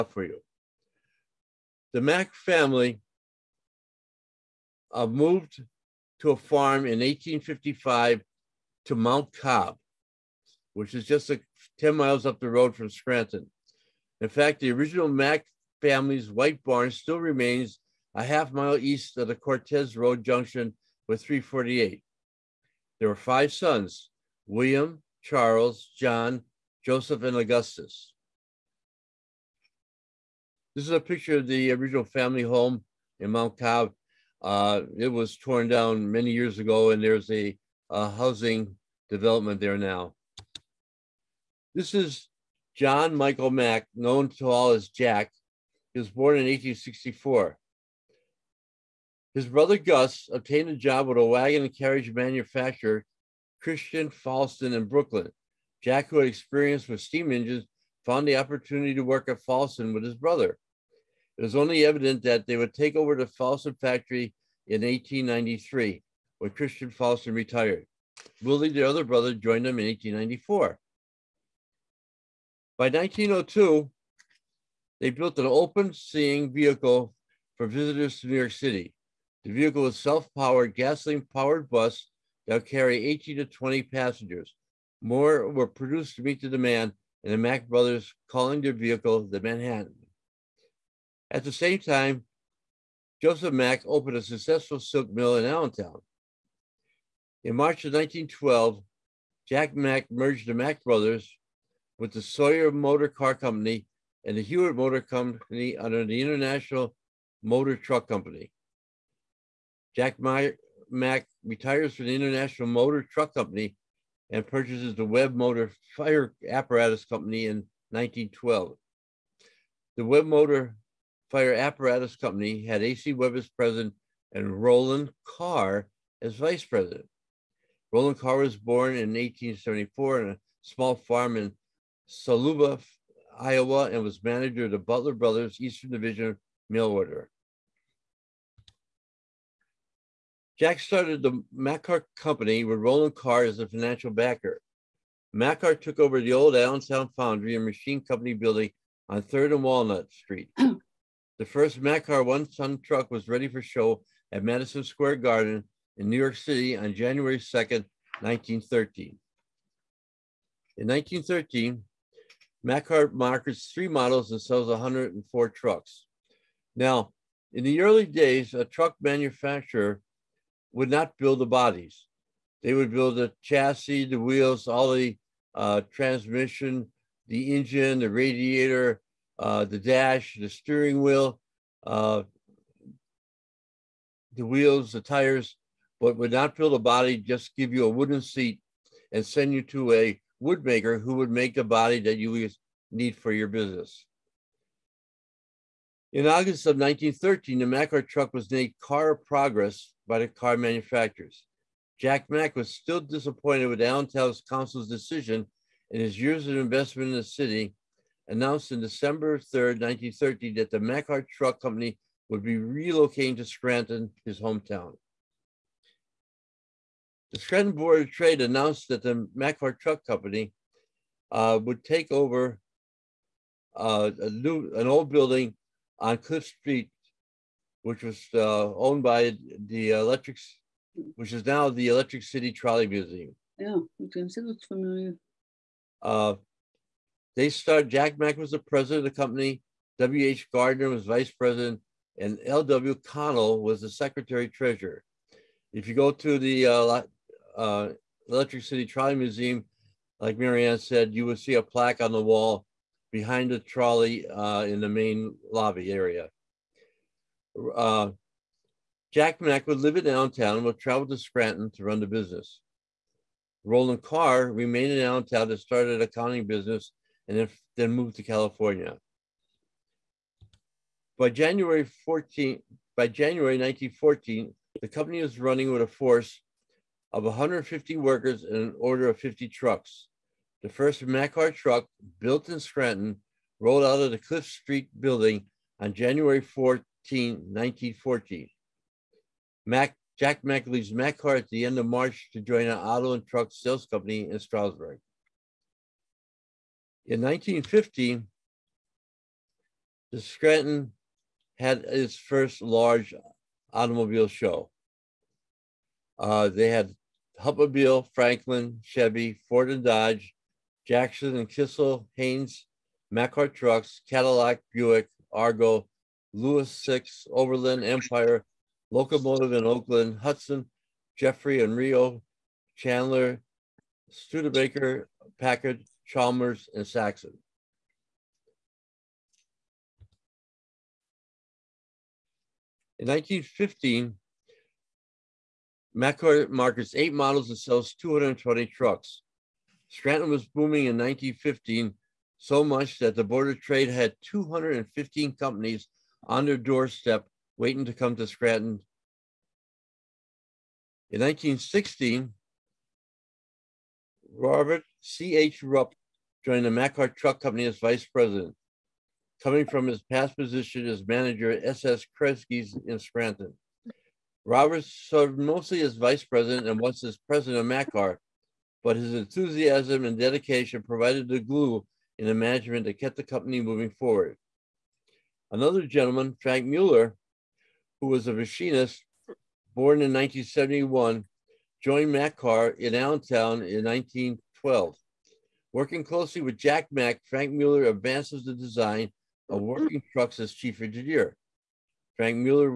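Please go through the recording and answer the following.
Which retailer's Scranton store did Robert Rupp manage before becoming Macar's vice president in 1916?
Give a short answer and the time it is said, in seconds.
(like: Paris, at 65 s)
S.S. Kresge's, at 361 s.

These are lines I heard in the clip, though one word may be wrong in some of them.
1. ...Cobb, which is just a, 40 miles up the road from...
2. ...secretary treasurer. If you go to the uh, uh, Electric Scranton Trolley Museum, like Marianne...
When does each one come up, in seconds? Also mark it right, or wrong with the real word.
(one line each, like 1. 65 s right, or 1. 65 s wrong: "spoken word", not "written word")
1. 9 s wrong: "10", not "40"
2. 243 s wrong: "City", not "Scranton".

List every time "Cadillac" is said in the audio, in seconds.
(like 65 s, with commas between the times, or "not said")
314 s.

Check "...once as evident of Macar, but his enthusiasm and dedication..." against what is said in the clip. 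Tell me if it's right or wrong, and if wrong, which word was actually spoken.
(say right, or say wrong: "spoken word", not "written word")
wrong: "president", not "evident".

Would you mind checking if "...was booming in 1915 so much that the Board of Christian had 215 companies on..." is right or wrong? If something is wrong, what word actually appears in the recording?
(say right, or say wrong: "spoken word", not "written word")
wrong: "Trade", not "Christian".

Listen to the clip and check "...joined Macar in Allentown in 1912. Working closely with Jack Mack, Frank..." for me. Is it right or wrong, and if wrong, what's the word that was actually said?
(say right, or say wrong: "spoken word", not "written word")
right.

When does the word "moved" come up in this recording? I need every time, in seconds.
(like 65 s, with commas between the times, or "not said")
5 s, 267 s.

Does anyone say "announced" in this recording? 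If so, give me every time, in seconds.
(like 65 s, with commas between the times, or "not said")
208 s, 218 s.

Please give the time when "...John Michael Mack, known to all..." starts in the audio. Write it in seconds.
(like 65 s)
42 s.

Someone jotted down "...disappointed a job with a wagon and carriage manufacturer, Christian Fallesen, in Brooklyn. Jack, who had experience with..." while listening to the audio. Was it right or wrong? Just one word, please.
wrong.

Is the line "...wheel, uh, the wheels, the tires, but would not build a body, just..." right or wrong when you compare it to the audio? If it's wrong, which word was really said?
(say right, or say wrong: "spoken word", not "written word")
right.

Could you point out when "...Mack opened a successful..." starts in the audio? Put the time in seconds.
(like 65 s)
93 s.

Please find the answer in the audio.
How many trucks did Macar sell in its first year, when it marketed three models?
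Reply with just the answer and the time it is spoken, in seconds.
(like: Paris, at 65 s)
104, at 164 s.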